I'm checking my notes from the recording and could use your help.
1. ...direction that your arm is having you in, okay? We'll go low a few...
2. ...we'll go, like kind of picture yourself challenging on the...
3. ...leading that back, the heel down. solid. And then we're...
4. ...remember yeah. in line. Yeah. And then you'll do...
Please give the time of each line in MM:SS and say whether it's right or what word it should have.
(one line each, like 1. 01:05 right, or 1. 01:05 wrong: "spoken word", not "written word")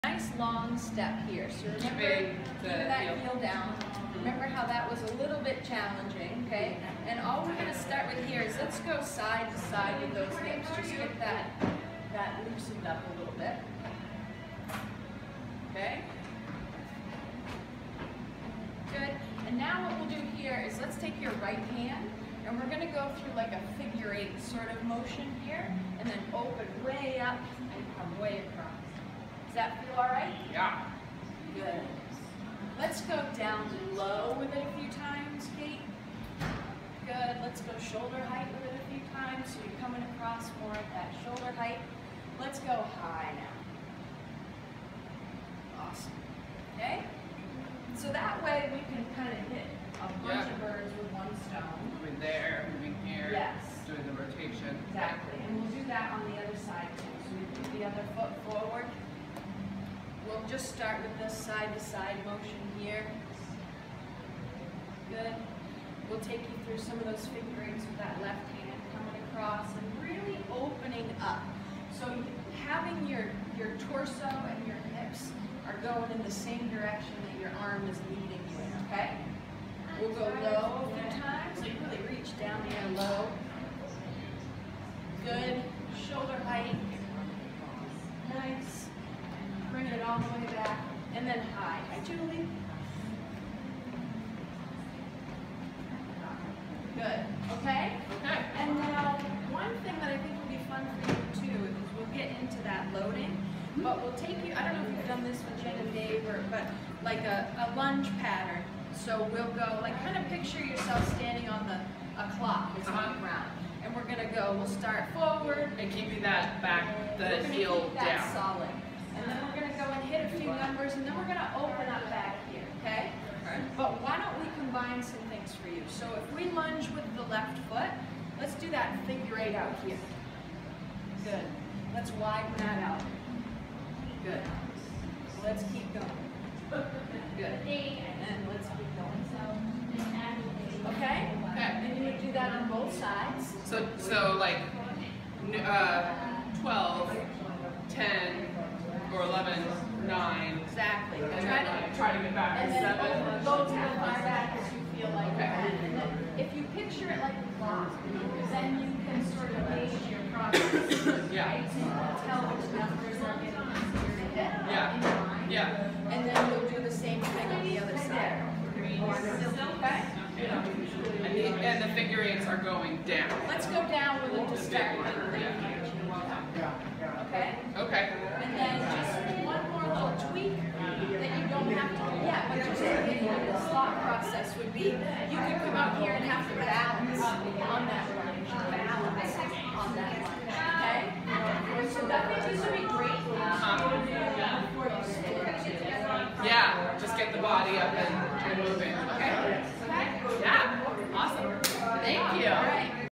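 1. 01:16 wrong: "leading", not "having"
2. 01:49 wrong: "standing", not "challenging"
3. 01:55 wrong: "keeping", not "leading"
4. 02:43 wrong: "easier", not "remember".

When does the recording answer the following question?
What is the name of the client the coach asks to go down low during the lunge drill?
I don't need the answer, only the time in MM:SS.
00:35.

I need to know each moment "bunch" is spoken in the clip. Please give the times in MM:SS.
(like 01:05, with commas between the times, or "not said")
00:50.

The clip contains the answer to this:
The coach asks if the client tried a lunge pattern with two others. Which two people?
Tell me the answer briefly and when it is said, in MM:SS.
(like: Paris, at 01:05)
Jen and Dave, at 01:45.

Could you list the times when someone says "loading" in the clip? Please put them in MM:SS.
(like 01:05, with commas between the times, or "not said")
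01:42.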